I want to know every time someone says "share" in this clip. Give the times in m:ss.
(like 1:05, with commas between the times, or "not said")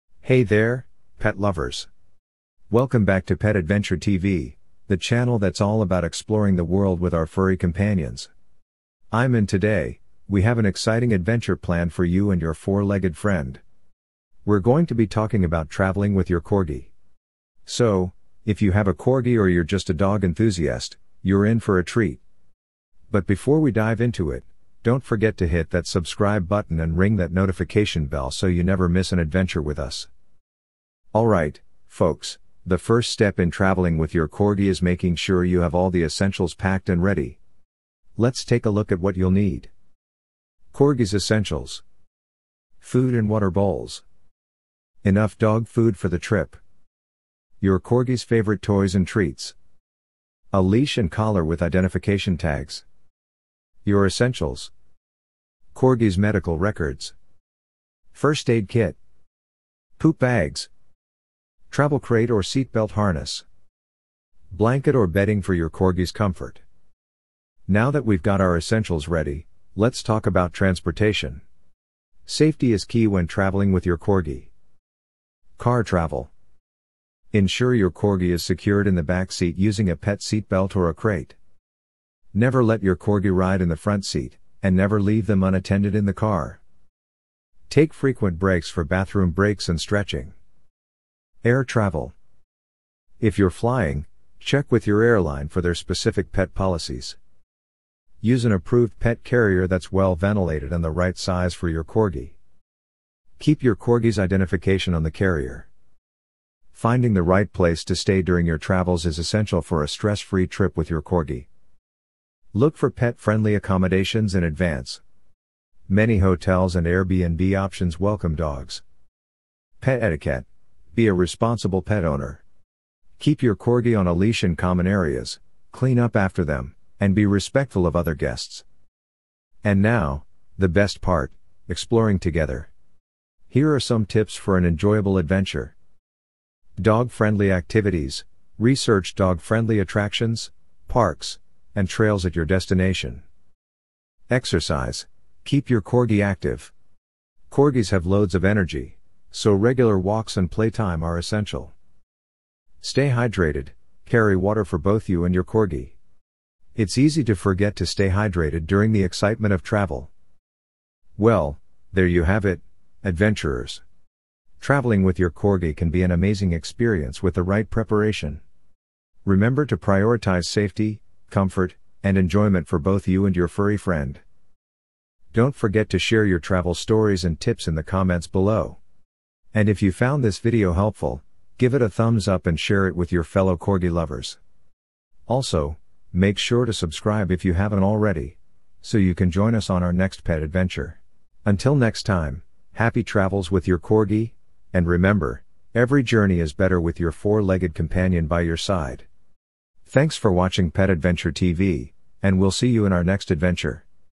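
2:55, 3:02.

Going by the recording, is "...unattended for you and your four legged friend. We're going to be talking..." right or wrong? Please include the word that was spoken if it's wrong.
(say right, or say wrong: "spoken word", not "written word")
wrong: "planned", not "unattended".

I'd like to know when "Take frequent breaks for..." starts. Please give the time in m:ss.
1:27.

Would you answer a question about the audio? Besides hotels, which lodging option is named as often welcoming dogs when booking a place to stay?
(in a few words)
Airbnb.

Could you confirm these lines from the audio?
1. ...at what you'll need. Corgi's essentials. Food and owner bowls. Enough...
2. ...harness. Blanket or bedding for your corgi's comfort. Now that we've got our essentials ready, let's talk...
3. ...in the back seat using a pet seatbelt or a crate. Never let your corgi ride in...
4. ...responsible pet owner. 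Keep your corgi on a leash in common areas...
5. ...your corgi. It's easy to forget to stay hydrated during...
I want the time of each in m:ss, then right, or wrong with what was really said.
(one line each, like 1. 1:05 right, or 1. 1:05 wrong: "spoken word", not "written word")
1. 0:38 wrong: "water", not "owner"
2. 1:02 right
3. 1:18 right
4. 2:01 right
5. 2:35 right.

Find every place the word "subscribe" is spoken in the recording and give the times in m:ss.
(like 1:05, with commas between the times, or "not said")
0:25, 3:06.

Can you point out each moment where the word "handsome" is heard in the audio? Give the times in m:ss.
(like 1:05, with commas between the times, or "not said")
not said.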